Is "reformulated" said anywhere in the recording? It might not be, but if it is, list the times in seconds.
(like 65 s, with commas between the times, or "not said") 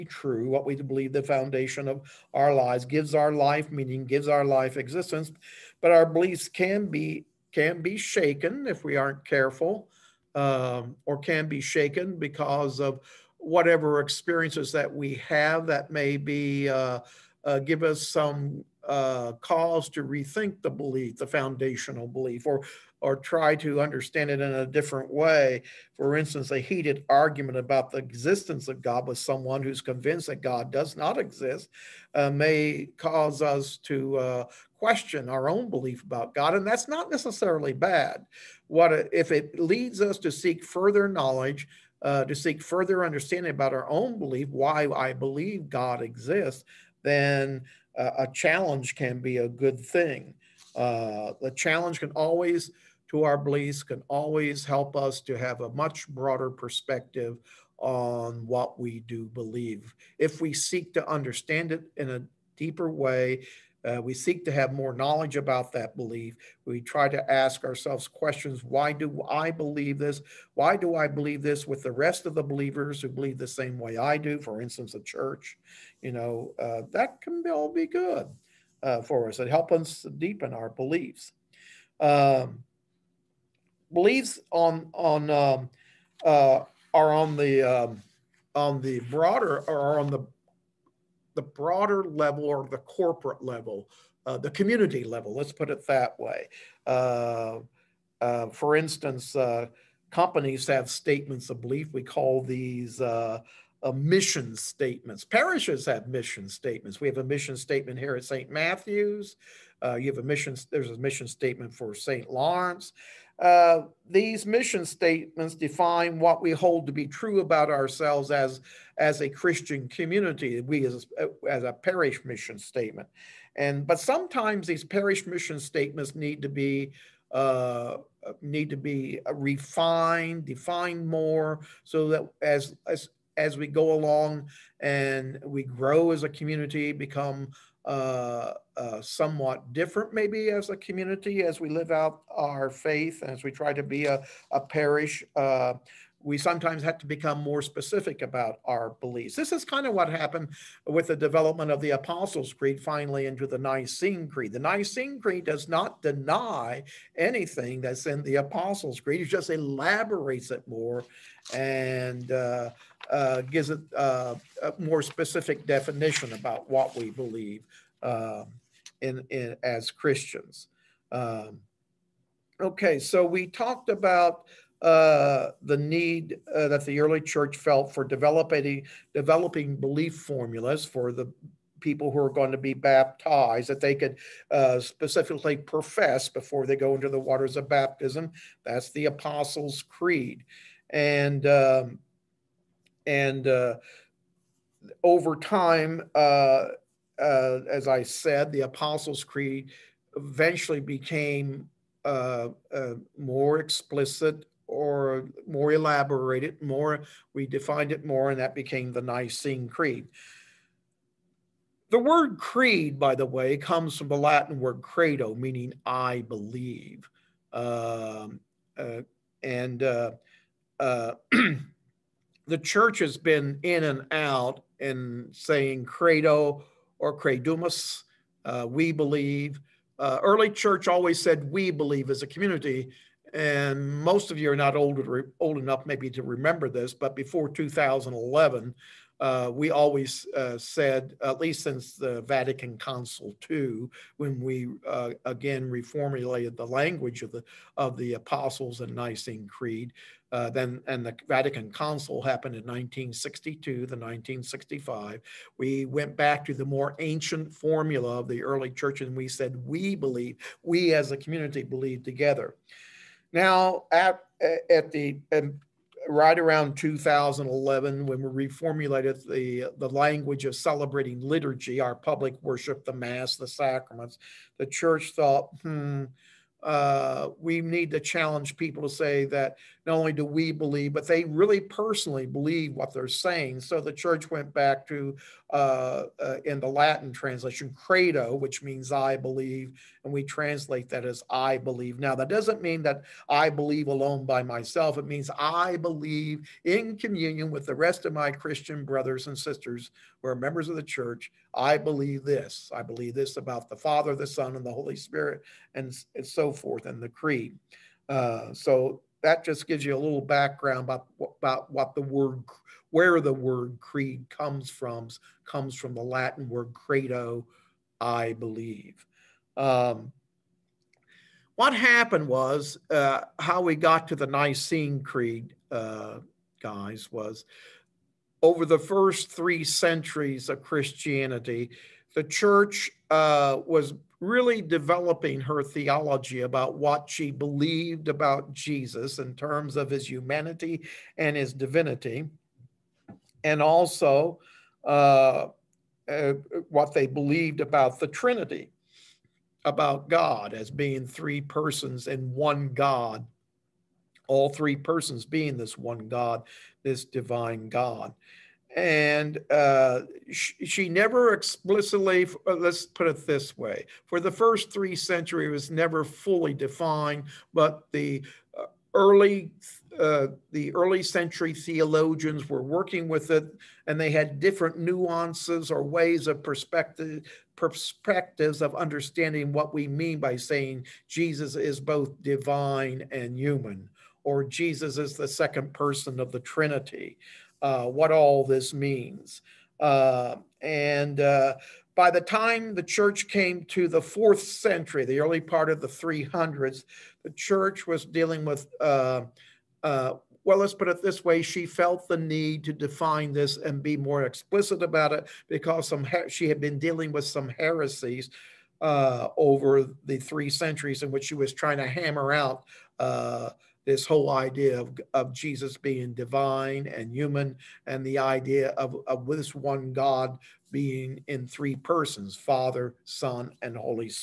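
245 s, 268 s.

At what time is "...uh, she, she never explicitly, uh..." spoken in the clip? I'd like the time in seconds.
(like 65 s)
359 s.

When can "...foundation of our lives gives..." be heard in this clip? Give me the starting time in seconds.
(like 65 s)
1 s.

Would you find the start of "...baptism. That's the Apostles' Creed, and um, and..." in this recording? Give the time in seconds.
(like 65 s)
187 s.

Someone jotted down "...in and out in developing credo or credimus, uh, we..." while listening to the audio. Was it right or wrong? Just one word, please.
wrong.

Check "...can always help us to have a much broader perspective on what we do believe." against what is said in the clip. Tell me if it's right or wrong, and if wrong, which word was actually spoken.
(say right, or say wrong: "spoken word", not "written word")
right.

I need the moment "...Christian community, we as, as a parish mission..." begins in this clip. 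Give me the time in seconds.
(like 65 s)
119 s.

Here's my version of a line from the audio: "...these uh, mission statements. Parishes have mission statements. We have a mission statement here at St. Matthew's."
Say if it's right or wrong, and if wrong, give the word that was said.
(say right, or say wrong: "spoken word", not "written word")
right.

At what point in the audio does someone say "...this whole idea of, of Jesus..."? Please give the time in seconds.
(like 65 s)
413 s.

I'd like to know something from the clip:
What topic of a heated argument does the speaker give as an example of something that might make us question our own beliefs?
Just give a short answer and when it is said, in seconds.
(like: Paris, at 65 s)
The existence of God, at 27 s.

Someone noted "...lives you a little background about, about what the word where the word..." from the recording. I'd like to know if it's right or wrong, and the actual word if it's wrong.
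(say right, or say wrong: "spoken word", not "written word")
wrong: "gives", not "lives".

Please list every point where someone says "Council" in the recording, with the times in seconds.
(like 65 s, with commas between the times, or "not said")
242 s, 251 s.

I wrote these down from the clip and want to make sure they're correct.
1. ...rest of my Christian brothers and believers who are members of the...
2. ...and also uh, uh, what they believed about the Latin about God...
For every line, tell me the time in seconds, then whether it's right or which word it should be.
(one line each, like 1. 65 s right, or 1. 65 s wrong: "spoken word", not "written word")
1. 297 s wrong: "sisters", not "believers"
2. 343 s wrong: "Trinity", not "Latin".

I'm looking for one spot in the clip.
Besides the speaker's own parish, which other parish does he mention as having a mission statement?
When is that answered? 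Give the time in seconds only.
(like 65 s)
111 s.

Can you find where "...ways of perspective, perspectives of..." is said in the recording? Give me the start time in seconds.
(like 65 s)
375 s.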